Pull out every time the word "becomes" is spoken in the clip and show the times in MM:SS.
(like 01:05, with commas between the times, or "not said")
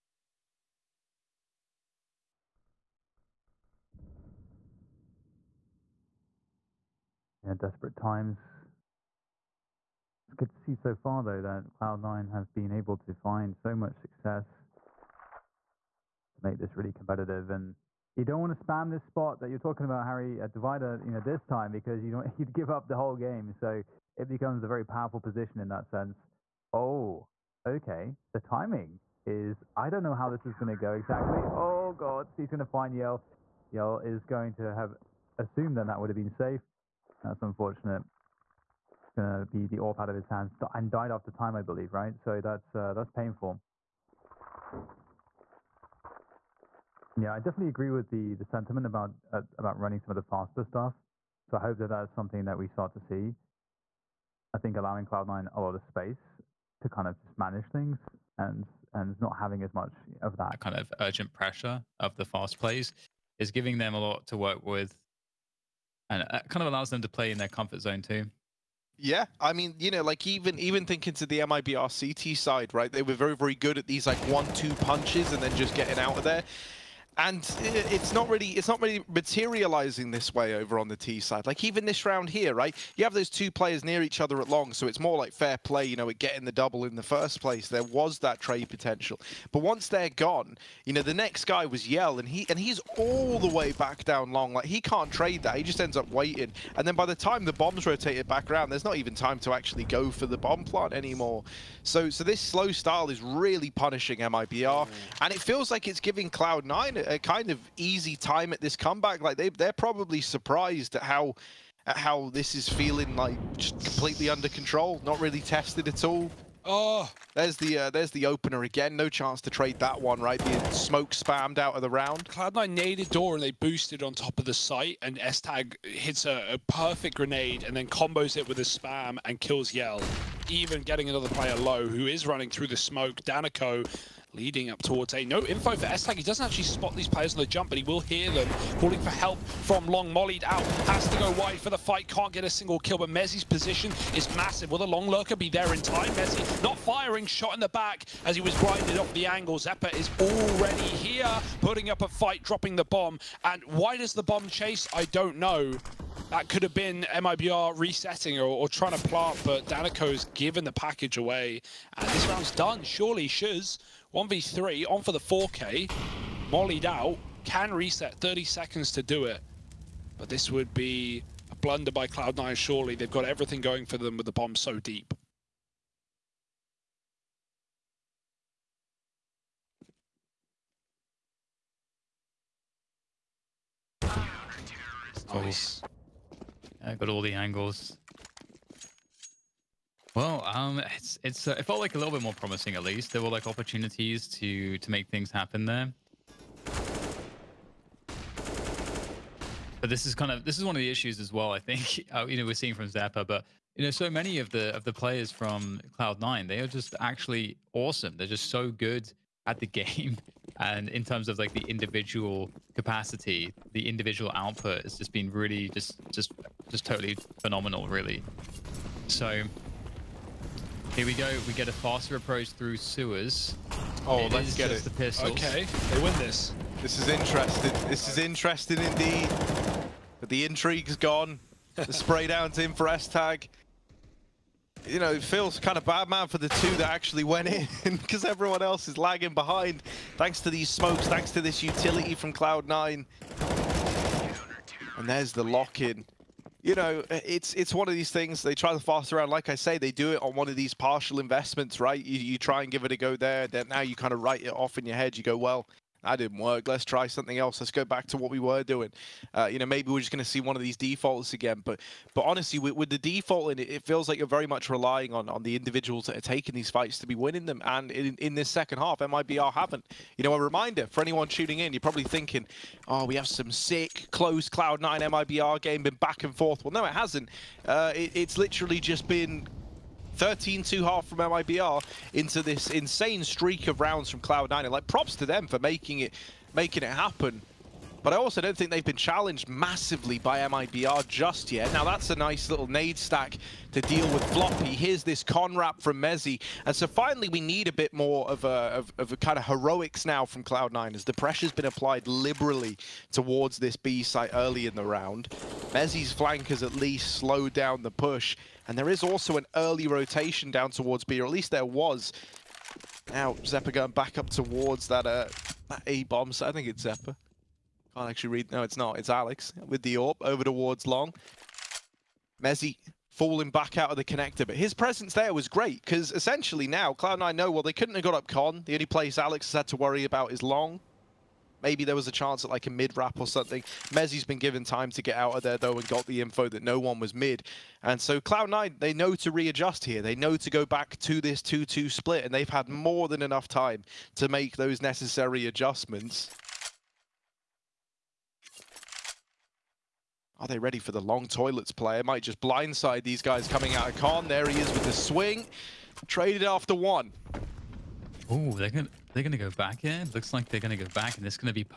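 00:24.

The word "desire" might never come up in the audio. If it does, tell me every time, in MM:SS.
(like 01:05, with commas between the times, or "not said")
not said.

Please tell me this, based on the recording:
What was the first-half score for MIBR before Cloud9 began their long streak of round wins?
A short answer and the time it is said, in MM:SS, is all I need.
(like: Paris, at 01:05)
13-2, at 04:40.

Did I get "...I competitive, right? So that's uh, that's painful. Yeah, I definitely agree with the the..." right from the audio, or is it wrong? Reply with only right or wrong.
wrong.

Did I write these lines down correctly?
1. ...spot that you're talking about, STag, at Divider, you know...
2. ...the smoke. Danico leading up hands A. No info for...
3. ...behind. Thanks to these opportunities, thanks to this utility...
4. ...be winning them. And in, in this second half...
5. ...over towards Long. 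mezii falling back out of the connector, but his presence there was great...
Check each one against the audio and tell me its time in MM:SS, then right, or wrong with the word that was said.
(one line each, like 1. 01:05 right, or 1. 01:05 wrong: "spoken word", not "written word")
1. 00:19 wrong: "Harry", not "STag"
2. 02:12 wrong: "towards", not "hands"
3. 03:59 wrong: "smokes", not "opportunities"
4. 04:27 right
5. 05:20 right.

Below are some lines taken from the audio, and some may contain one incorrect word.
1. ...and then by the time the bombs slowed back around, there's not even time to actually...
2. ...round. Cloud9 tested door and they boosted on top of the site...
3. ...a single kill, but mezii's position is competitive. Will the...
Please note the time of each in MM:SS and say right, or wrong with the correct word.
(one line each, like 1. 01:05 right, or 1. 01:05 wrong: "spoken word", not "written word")
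1. 01:36 wrong: "rotated", not "slowed"
2. 02:01 wrong: "naded", not "tested"
3. 02:22 wrong: "massive", not "competitive".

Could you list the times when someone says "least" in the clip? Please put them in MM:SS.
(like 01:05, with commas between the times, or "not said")
03:12, 05:06, 05:11.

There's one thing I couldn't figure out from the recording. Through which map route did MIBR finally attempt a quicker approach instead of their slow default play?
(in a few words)
Sewers.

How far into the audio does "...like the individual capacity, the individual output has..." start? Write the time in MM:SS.
03:31.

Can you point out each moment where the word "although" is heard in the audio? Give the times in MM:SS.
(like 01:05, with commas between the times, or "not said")
not said.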